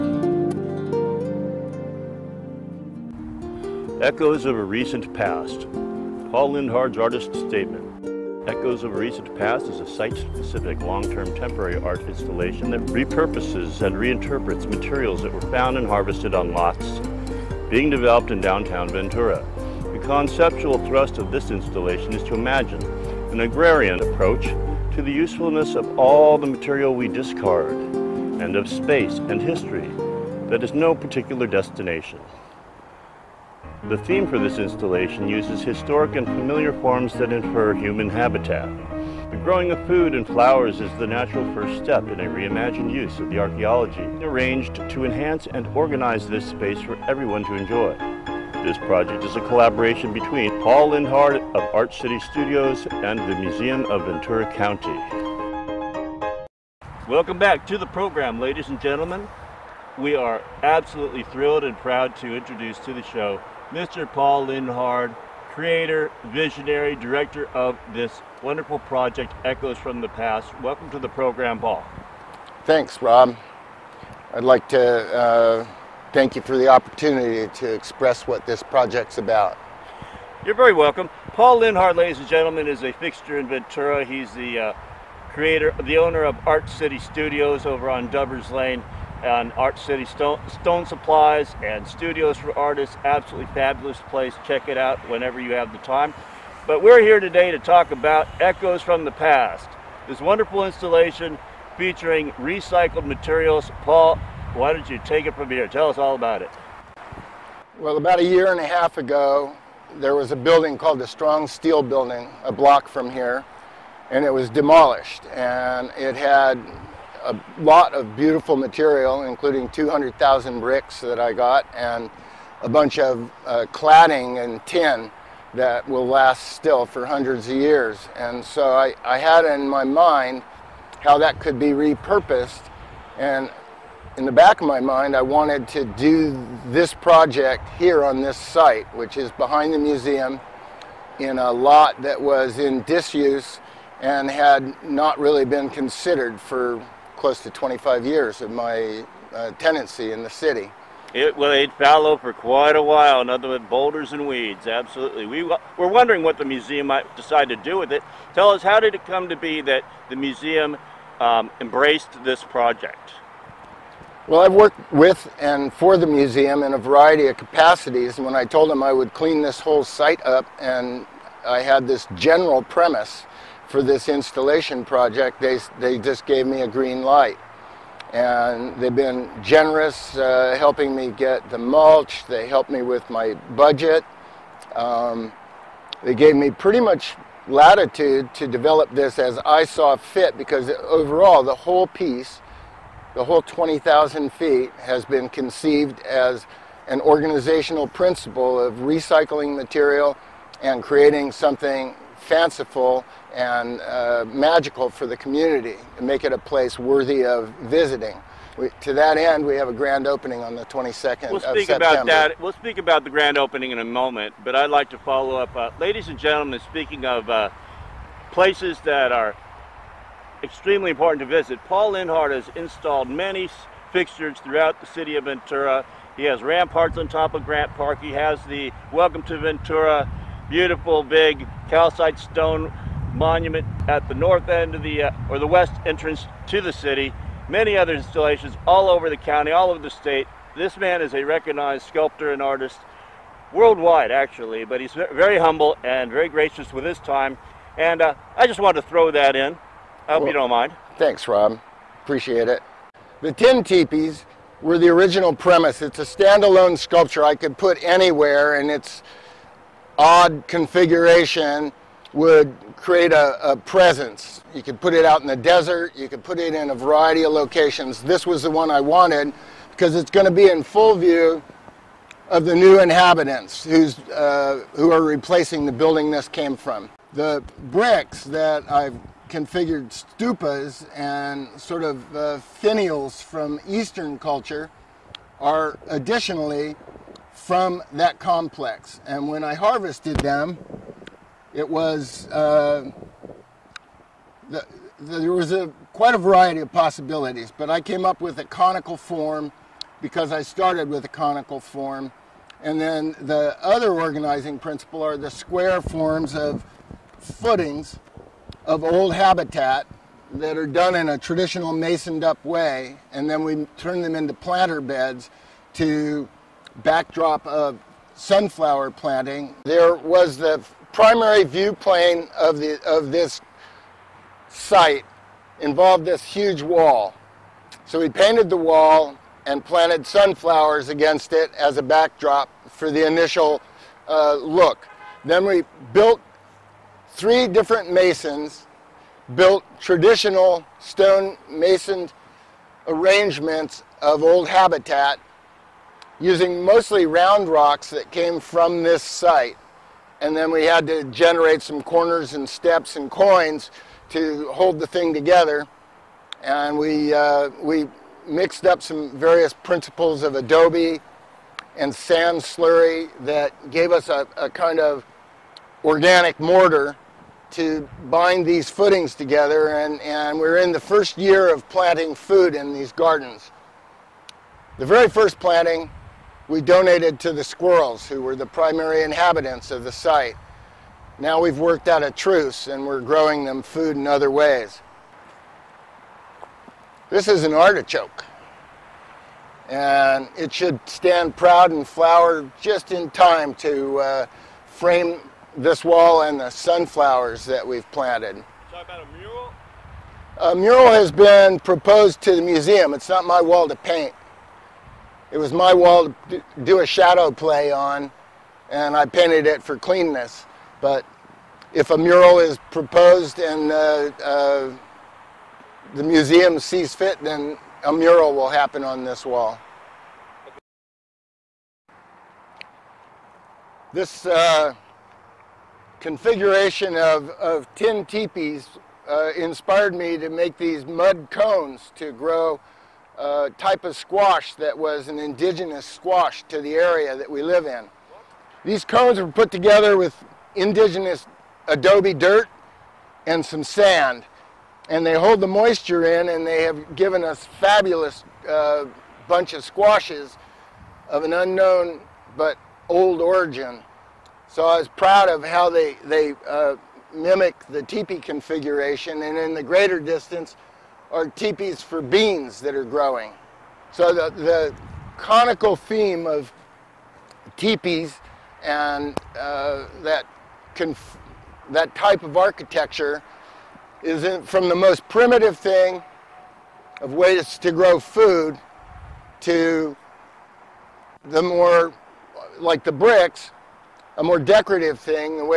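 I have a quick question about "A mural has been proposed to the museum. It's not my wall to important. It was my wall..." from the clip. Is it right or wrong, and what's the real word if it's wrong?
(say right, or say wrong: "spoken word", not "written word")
wrong: "paint", not "important".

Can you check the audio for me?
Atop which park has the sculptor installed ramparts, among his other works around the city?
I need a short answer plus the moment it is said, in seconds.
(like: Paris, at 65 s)
Grant Park, at 227 s.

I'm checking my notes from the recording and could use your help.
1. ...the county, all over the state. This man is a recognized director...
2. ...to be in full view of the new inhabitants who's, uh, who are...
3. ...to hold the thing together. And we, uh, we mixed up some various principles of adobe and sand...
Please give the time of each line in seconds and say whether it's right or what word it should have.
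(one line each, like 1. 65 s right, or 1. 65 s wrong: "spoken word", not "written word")
1. 239 s wrong: "sculptor", not "director"
2. 270 s right
3. 354 s right.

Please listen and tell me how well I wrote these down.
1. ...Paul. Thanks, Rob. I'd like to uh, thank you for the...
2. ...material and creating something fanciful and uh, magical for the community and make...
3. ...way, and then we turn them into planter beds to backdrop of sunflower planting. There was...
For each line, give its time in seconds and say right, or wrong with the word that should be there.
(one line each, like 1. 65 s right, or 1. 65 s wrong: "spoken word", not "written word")
1. 71 s right
2. 199 s right
3. 312 s right.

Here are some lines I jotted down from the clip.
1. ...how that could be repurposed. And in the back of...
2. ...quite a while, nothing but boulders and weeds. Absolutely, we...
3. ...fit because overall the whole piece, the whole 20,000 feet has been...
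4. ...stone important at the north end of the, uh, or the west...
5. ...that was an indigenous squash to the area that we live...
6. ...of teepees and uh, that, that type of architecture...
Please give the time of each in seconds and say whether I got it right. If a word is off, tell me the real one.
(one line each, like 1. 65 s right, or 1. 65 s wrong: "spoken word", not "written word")
1. 131 s right
2. 152 s right
3. 189 s right
4. 232 s wrong: "monument", not "important"
5. 434 s right
6. 466 s right.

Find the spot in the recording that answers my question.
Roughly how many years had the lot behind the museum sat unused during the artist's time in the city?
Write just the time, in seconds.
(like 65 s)
147 s.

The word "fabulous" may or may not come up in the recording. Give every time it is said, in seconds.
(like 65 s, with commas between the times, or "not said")
93 s, 447 s.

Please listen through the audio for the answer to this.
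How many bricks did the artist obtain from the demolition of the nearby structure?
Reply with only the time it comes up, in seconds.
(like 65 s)
119 s.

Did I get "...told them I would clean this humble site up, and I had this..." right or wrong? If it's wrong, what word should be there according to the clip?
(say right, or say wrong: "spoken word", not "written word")
wrong: "whole", not "humble".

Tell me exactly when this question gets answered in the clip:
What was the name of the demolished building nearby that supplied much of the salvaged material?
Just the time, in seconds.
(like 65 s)
111 s.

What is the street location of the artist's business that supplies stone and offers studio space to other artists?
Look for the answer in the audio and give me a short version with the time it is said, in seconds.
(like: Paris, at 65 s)
Dubbers Lane, at 88 s.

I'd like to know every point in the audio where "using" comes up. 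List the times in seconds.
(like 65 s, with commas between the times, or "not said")
346 s.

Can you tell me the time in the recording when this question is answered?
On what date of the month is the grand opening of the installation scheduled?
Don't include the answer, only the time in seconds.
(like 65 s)
210 s.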